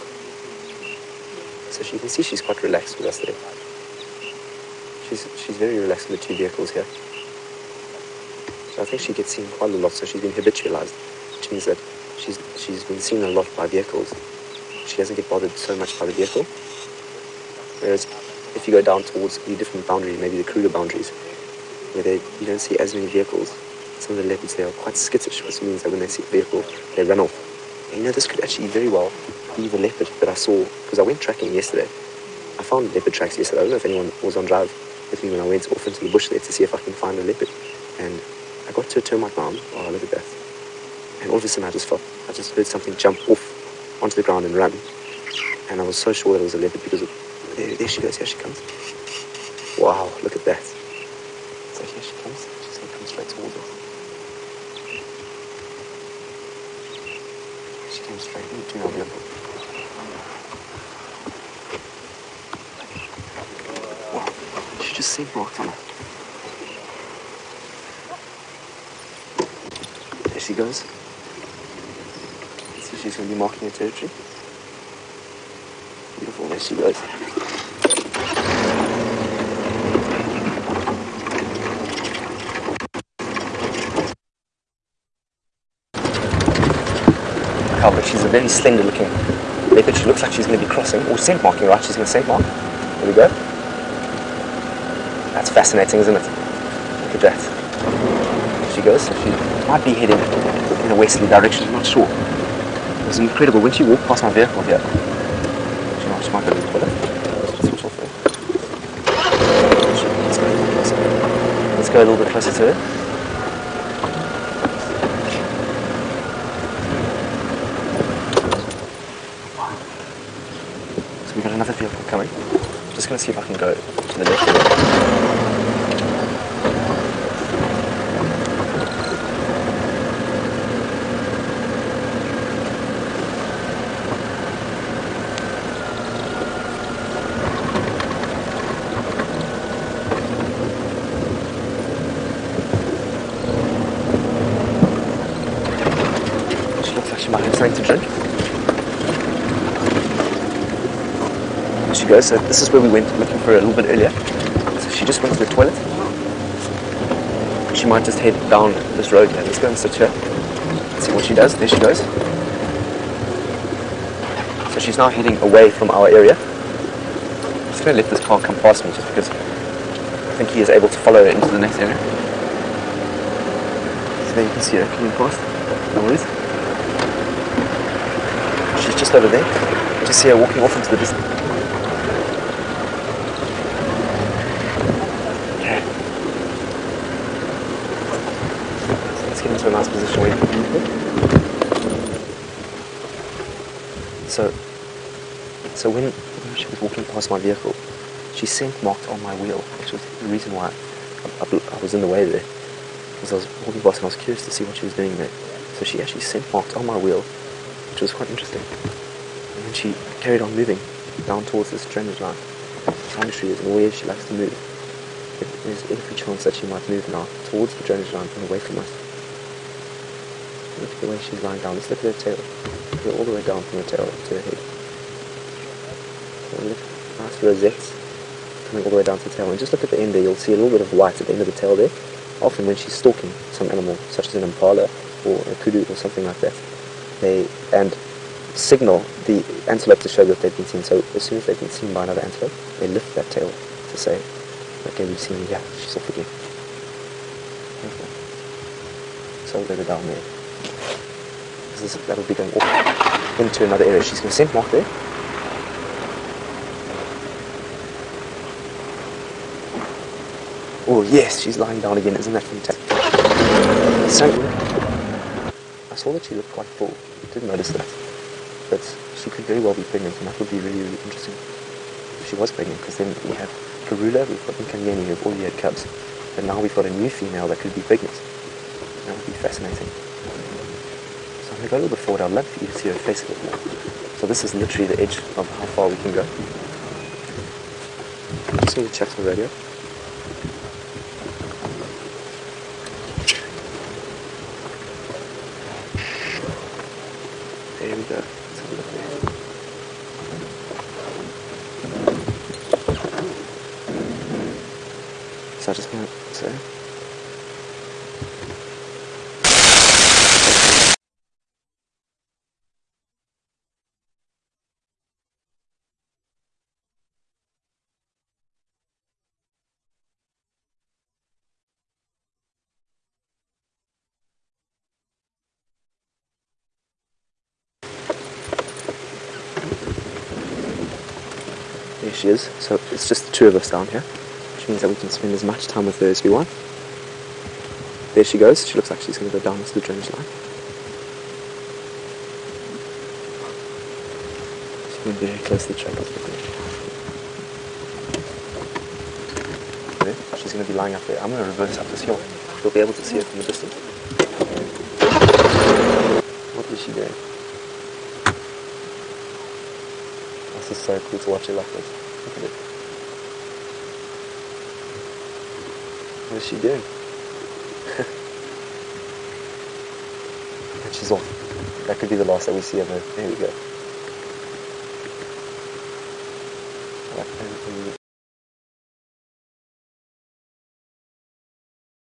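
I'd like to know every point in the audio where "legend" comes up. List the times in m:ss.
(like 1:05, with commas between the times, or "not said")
not said.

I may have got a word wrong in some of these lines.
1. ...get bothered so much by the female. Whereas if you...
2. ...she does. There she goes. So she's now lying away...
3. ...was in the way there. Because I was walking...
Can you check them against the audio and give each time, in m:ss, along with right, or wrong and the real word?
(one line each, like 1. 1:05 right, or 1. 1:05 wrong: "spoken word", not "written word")
1. 0:15 wrong: "vehicle", not "female"
2. 2:41 wrong: "heading", not "lying"
3. 3:21 right.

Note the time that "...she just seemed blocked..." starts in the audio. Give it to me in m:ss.
1:04.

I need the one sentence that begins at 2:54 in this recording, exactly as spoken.
So there you can see it coming past.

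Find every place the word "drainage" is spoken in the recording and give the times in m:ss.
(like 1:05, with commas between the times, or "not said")
3:31, 3:37, 5:39.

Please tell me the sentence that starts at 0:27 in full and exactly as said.
And, you know, this could actually very well be the leopard that I saw because I went tracking yesterday.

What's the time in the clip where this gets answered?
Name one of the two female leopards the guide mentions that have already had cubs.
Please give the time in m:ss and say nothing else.
4:33.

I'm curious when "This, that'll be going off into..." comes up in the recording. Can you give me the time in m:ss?
4:11.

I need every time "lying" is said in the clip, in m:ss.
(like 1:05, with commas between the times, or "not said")
3:41, 4:21, 5:50.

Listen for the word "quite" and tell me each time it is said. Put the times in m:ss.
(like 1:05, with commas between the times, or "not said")
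0:02, 0:09, 0:24, 3:28, 4:26.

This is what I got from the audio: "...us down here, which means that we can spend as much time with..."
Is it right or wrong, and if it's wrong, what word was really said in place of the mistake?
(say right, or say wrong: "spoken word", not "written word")
right.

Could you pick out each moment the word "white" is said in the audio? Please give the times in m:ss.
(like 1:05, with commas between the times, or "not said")
3:50.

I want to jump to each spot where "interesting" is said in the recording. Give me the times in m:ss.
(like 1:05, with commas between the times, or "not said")
3:28, 4:31.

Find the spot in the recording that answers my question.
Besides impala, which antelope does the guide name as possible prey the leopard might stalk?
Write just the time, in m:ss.
3:55.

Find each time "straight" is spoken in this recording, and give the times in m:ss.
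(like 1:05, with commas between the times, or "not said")
0:53, 0:58.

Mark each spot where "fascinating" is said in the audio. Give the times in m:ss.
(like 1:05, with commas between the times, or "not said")
1:35, 4:39.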